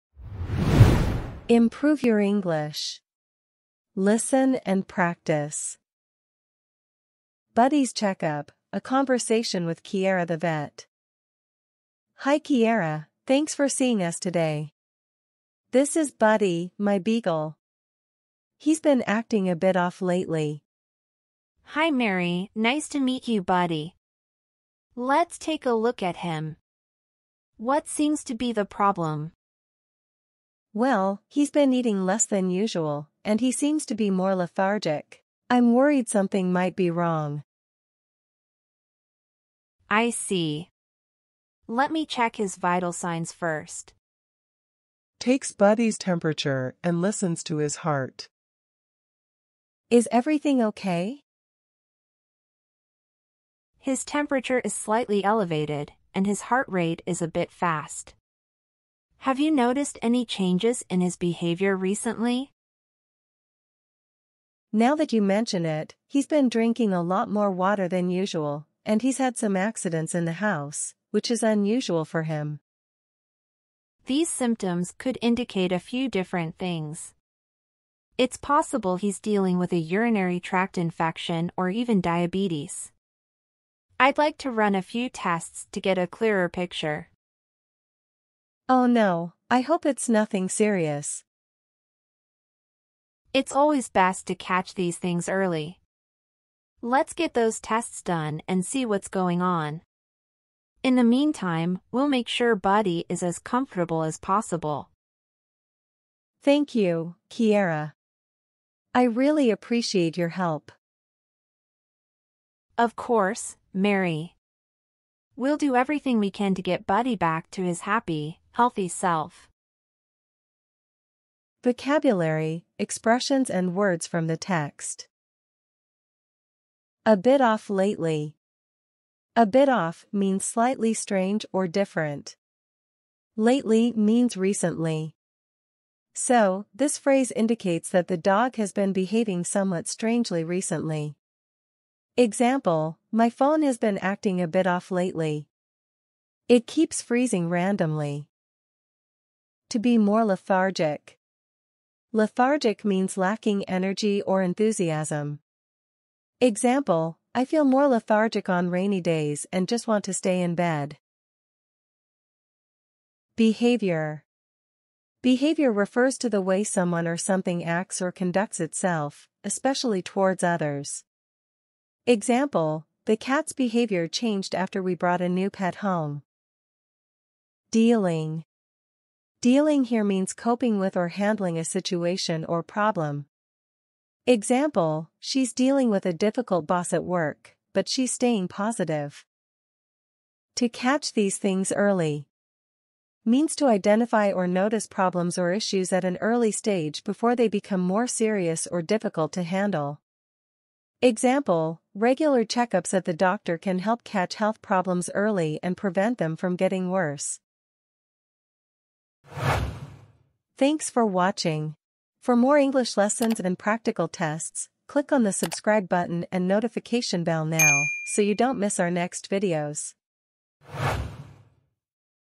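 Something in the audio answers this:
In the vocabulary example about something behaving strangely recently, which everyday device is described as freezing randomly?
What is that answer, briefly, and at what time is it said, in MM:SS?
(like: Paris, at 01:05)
phone, at 02:23.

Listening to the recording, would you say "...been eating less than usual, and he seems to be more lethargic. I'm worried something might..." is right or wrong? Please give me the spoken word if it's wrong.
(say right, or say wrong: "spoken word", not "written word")
right.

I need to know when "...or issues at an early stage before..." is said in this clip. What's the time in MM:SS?
03:15.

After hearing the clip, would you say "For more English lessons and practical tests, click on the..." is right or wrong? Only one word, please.
right.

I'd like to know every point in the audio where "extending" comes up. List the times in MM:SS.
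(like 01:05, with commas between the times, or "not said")
not said.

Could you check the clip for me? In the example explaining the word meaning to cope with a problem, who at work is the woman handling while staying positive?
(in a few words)
a difficult boss.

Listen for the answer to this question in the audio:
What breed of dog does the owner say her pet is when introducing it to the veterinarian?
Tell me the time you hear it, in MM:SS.
00:16.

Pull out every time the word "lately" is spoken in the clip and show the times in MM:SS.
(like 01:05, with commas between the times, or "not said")
00:20, 02:07, 02:13, 02:24.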